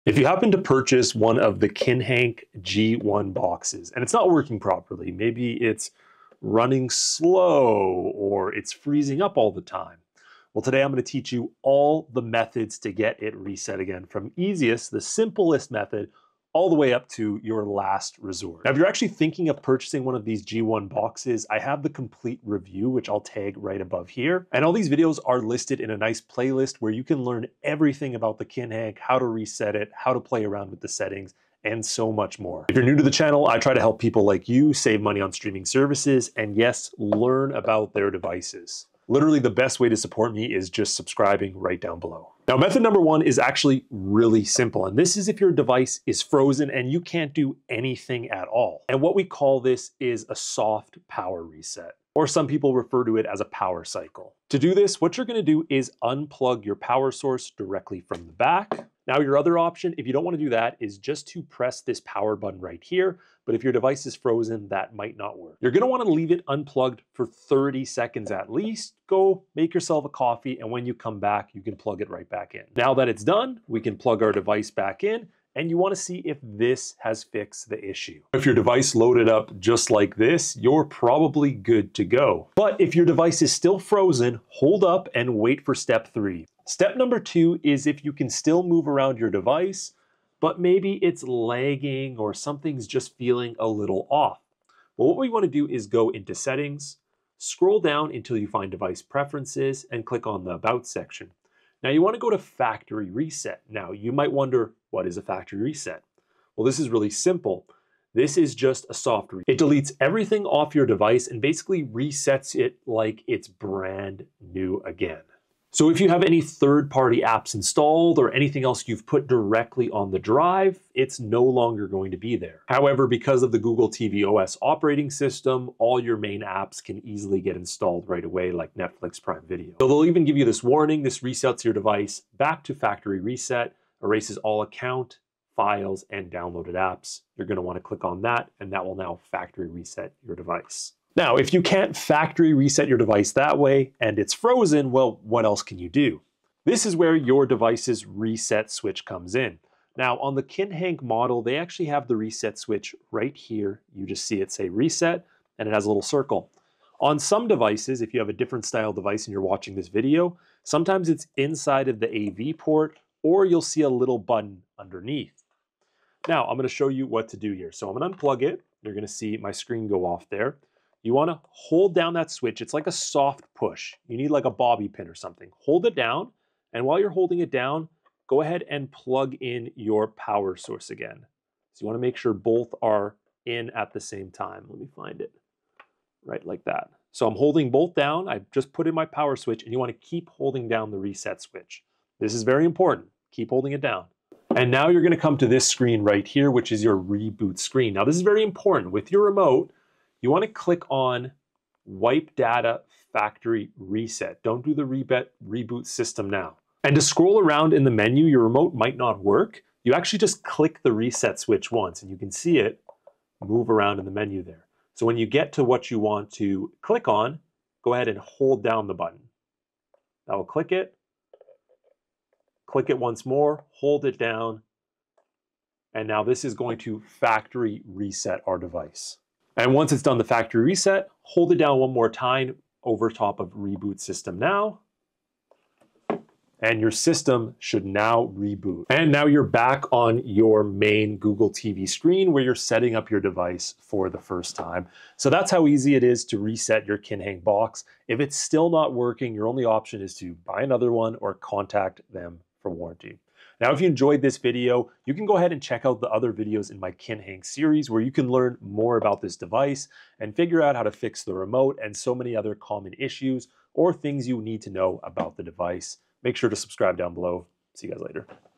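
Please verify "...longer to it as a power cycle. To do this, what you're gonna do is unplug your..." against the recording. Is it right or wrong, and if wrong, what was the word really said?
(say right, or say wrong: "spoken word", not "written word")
wrong: "refer", not "longer".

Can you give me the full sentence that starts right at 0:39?
Literally the best way to support me is just subscribing right down below.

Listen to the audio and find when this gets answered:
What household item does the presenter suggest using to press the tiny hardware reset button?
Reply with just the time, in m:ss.
2:54.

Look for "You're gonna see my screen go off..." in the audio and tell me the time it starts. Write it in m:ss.
2:48.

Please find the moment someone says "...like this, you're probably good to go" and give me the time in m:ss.
1:19.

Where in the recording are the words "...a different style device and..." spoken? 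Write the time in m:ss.
2:38.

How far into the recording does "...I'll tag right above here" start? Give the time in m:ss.
0:23.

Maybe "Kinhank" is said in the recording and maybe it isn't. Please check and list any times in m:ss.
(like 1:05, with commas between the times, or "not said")
0:01, 0:28, 2:30, 4:06, 4:16.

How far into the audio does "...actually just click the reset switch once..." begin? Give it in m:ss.
3:29.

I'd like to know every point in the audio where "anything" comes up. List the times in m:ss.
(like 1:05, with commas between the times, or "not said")
0:47, 1:58.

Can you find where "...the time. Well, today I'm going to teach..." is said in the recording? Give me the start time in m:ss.
0:09.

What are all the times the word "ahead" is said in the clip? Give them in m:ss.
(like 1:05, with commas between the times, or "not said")
2:58, 3:37, 4:15.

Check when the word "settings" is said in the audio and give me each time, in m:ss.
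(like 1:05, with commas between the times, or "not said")
0:30, 1:36, 4:02.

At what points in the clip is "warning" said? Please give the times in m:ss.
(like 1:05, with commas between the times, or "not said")
2:10.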